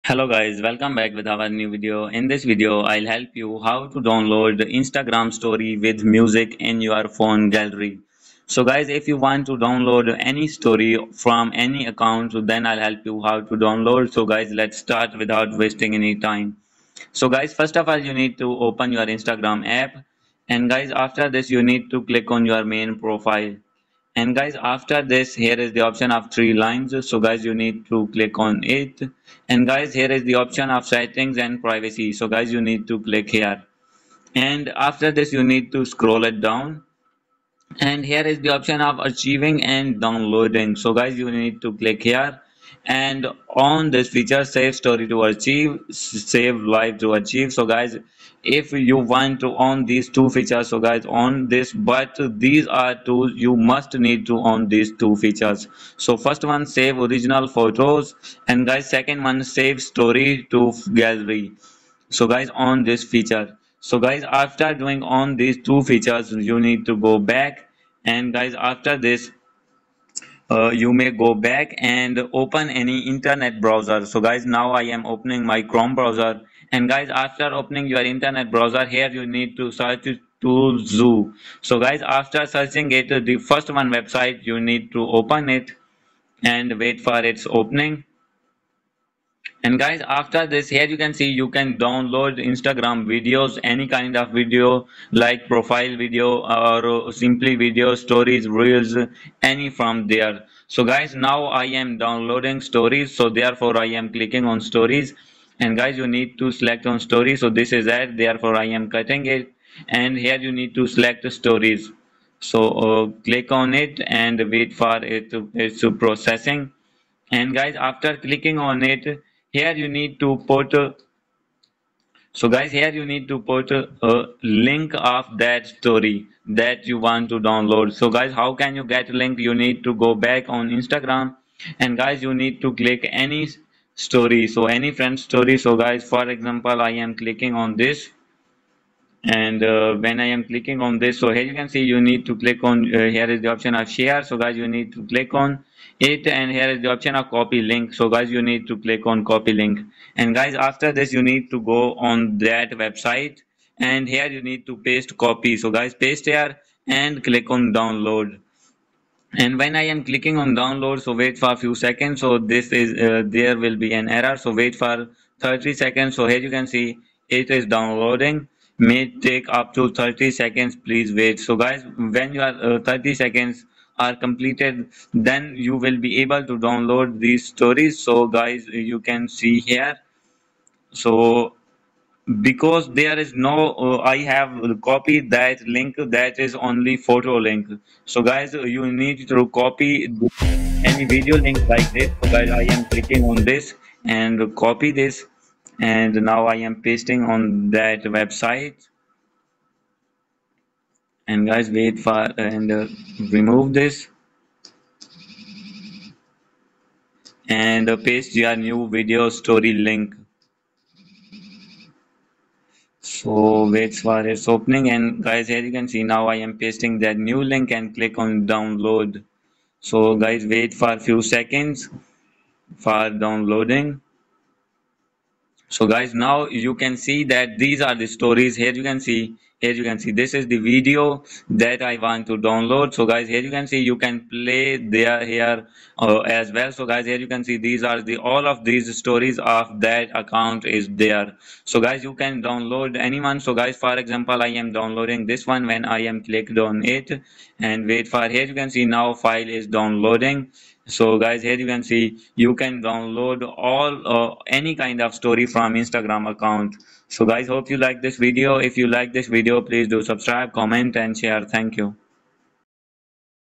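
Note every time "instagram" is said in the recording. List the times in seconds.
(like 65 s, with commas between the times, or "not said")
4 s, 19 s, 92 s, 130 s, 255 s.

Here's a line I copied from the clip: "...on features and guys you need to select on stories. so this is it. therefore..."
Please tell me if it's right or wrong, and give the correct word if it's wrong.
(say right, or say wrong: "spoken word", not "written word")
wrong: "stories", not "features".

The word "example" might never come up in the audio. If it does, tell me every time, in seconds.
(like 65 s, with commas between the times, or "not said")
136 s, 243 s.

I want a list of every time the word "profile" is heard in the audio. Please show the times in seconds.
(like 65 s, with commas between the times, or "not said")
23 s, 95 s.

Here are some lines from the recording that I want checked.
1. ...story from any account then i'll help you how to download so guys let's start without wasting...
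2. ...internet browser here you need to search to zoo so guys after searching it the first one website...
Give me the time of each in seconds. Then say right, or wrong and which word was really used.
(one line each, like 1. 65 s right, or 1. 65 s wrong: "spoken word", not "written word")
1. 10 s right
2. 78 s right.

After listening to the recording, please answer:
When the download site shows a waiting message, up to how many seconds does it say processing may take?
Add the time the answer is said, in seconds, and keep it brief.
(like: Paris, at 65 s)
30, at 168 s.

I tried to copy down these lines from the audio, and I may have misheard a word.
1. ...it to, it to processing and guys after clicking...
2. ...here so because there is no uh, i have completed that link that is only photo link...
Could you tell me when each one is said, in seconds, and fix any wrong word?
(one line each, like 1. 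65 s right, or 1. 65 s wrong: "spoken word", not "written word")
1. 115 s right
2. 179 s wrong: "copied", not "completed".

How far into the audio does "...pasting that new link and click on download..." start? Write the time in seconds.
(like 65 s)
216 s.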